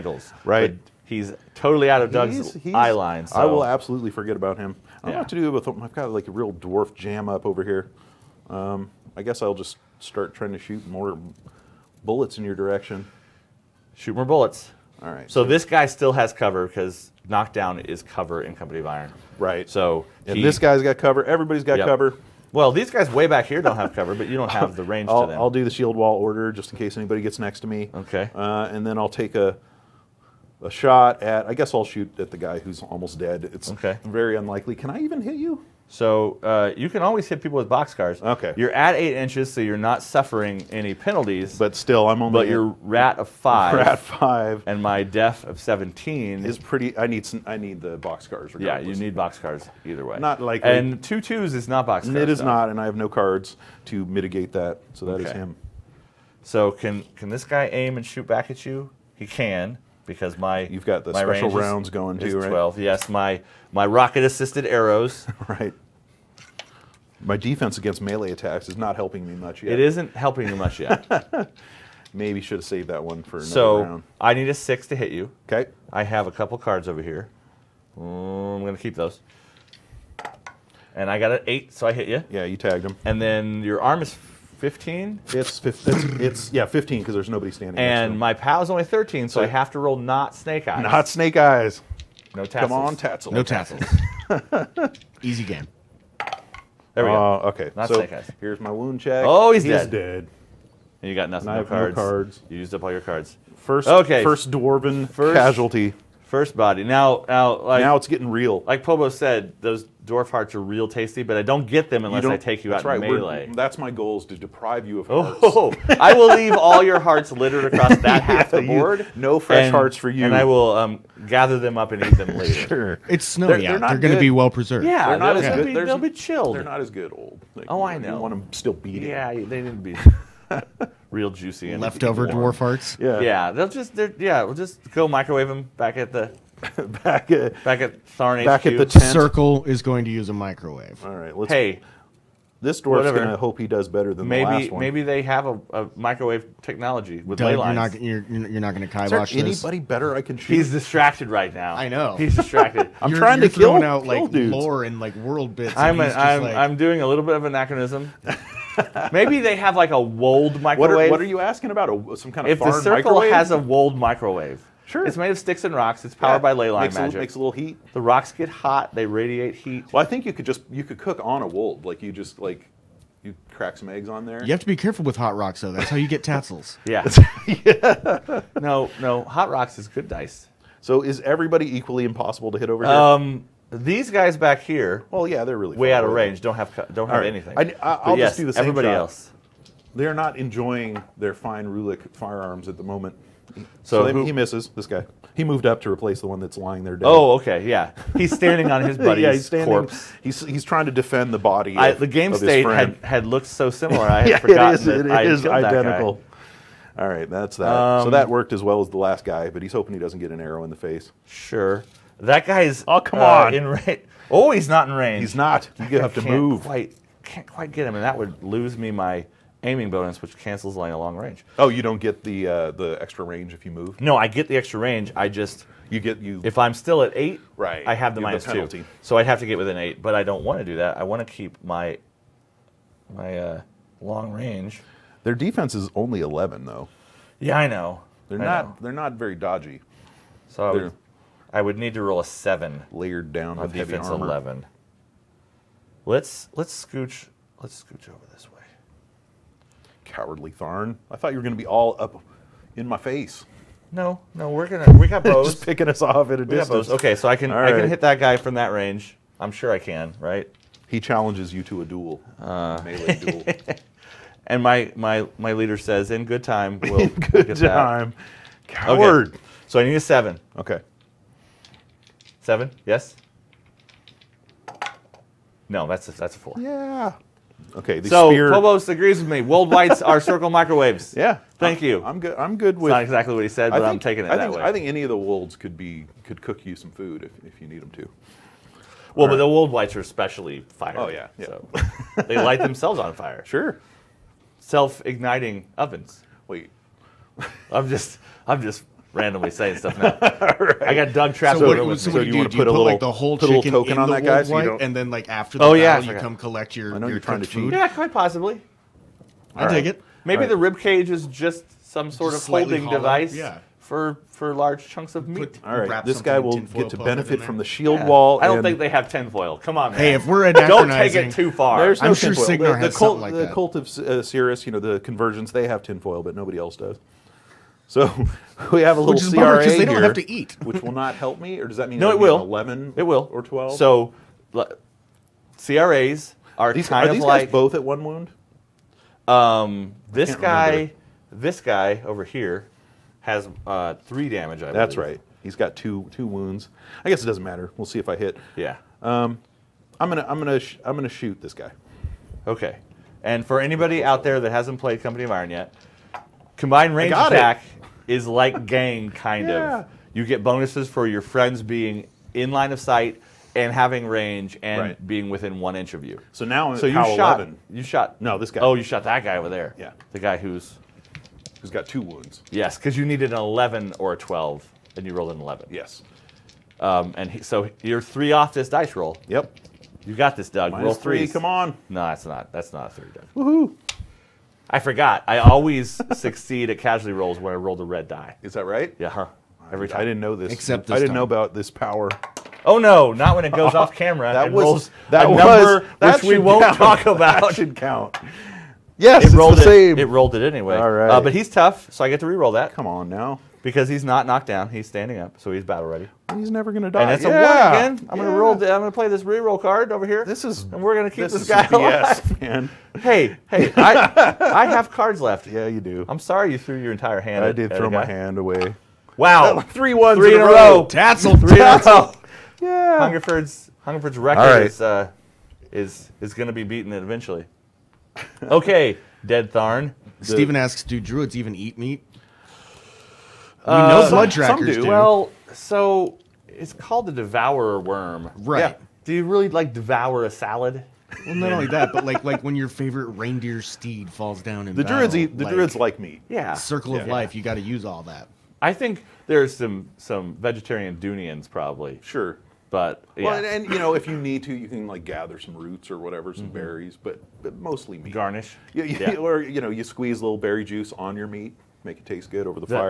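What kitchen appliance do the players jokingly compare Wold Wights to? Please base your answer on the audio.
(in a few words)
circle microwaves.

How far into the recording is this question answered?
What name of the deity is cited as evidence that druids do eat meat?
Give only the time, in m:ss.
7:17.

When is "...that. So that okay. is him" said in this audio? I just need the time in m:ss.
0:54.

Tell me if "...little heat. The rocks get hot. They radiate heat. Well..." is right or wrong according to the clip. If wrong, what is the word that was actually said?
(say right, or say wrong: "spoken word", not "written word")
right.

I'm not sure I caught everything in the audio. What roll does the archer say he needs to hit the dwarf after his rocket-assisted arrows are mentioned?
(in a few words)
6.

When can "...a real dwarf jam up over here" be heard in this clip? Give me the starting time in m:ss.
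0:06.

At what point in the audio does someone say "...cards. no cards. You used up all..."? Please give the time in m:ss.
1:41.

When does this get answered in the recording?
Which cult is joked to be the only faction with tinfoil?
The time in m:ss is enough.
5:23.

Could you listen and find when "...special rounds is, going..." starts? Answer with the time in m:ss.
1:01.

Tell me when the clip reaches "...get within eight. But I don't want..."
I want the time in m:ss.
3:49.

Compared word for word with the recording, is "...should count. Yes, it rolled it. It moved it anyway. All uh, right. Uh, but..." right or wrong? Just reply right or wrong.
wrong.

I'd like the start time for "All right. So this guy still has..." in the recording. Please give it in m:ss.
0:15.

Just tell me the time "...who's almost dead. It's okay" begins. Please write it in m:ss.
0:32.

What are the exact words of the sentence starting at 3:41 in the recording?
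Oh, you don't get the uh, the extra range if you move.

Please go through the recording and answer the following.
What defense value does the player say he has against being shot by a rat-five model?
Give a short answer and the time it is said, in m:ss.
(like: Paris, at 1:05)
17, at 0:45.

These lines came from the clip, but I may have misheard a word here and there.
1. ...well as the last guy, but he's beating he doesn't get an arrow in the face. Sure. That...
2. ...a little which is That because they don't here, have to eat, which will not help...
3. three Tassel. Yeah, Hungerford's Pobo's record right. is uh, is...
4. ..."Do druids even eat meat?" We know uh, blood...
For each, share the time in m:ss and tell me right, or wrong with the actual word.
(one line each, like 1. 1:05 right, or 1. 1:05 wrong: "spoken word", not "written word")
1. 3:28 wrong: "hoping", not "beating"
2. 5:28 wrong: "CRA", not "That"
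3. 7:00 wrong: "Hungerford", not "Pobo"
4. 7:10 right.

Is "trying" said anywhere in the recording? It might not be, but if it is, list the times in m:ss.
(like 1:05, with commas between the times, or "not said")
0:10, 2:33, 3:20, 5:07.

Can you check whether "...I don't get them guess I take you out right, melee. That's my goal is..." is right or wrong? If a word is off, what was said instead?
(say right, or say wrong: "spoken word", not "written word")
wrong: "unless", not "guess".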